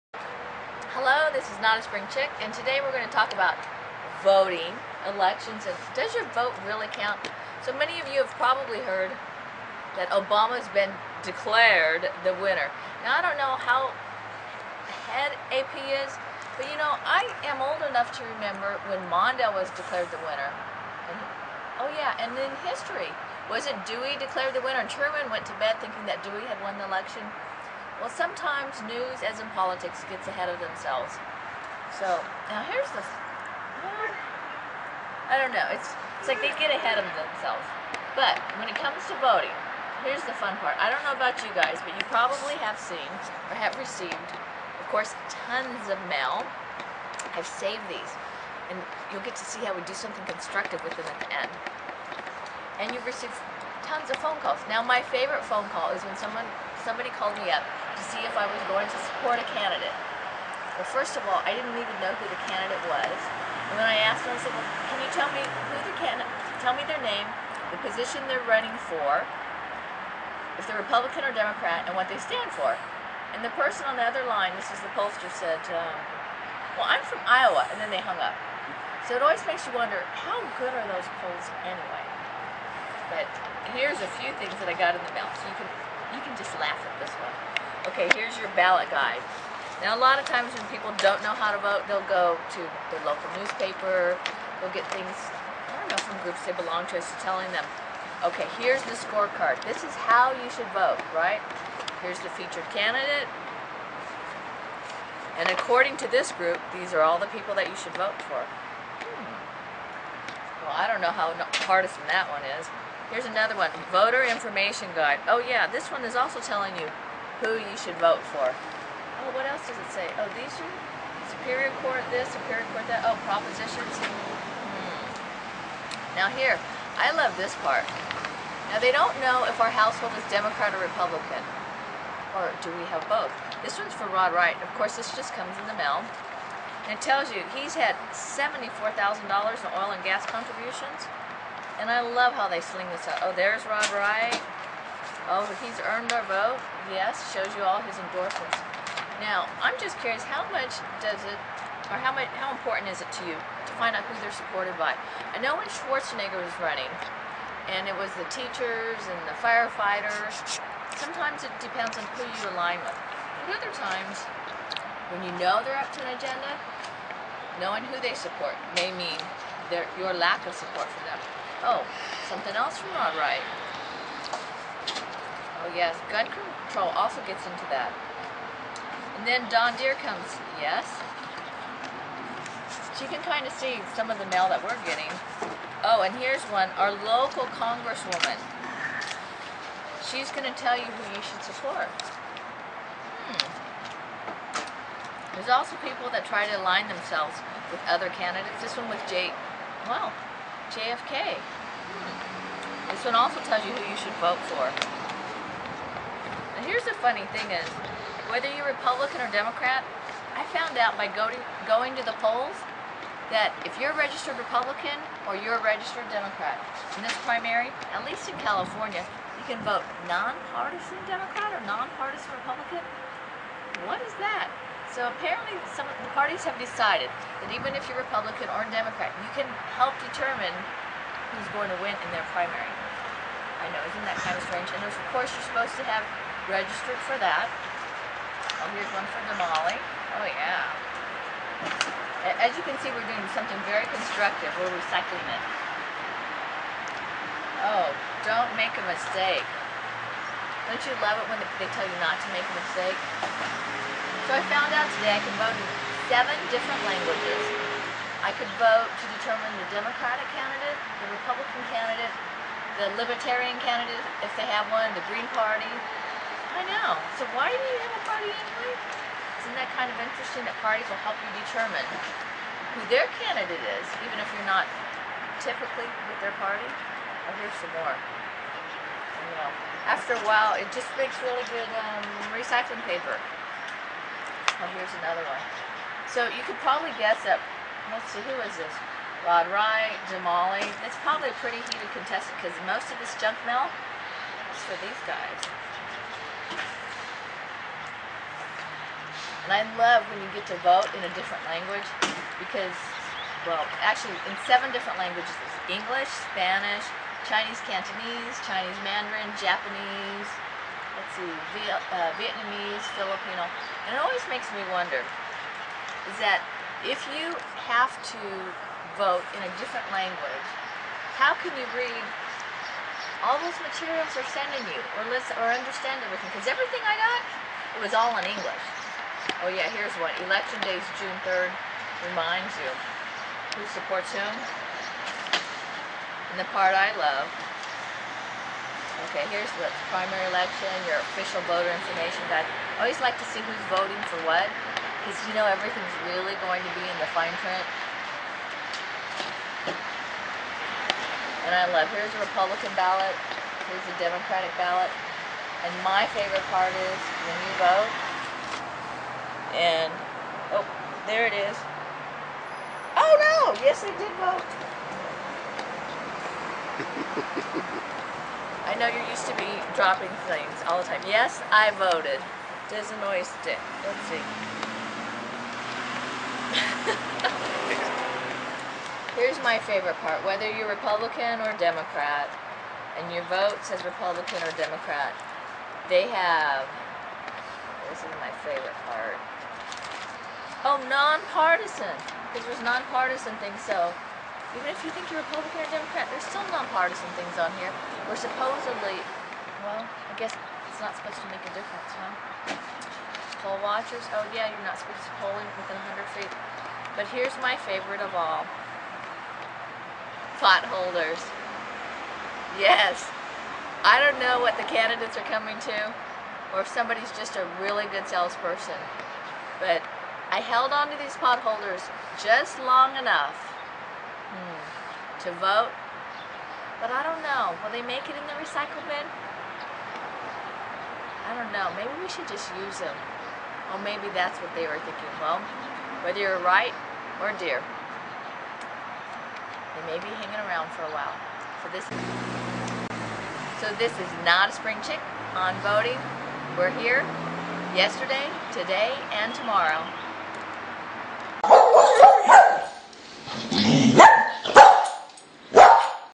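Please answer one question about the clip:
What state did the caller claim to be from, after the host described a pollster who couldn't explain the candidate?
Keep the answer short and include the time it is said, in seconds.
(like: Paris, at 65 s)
Iowa, at 77 s.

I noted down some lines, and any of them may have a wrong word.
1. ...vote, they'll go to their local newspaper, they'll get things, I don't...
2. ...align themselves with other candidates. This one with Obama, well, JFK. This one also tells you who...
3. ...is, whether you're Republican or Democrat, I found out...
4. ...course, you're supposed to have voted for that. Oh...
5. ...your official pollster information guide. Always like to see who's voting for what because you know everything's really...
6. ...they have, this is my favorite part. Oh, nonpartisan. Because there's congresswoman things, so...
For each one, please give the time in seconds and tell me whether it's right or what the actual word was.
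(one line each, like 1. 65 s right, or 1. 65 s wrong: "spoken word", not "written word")
1. 91 s right
2. 196 s wrong: "Jake", not "Obama"
3. 207 s right
4. 235 s wrong: "registered", not "voted"
5. 340 s wrong: "voter", not "pollster"
6. 385 s wrong: "nonpartisan", not "congresswoman".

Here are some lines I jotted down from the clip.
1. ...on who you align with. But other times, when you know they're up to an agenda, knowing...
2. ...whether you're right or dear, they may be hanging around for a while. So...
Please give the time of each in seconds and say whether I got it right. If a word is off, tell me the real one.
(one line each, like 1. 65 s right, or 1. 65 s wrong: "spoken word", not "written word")
1. 161 s right
2. 436 s right.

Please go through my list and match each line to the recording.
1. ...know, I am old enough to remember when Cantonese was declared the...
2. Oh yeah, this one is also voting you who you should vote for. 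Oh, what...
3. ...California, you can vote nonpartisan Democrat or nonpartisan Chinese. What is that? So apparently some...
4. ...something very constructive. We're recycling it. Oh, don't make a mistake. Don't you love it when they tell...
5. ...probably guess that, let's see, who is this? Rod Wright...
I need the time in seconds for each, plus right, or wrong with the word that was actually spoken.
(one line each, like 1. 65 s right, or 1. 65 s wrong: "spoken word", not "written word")
1. 16 s wrong: "Mondale", not "Cantonese"
2. 115 s wrong: "telling", not "voting"
3. 218 s wrong: "Republican", not "Chinese"
4. 243 s right
5. 286 s right.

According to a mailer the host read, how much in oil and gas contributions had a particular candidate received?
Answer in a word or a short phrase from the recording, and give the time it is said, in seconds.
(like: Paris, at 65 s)
$74,000, at 138 s.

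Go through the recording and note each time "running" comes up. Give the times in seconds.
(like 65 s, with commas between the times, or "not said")
68 s, 156 s.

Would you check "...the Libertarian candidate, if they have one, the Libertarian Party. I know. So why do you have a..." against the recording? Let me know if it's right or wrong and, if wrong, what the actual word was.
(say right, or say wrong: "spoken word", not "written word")
wrong: "Green", not "Libertarian".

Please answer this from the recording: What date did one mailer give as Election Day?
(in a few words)
June 3rd.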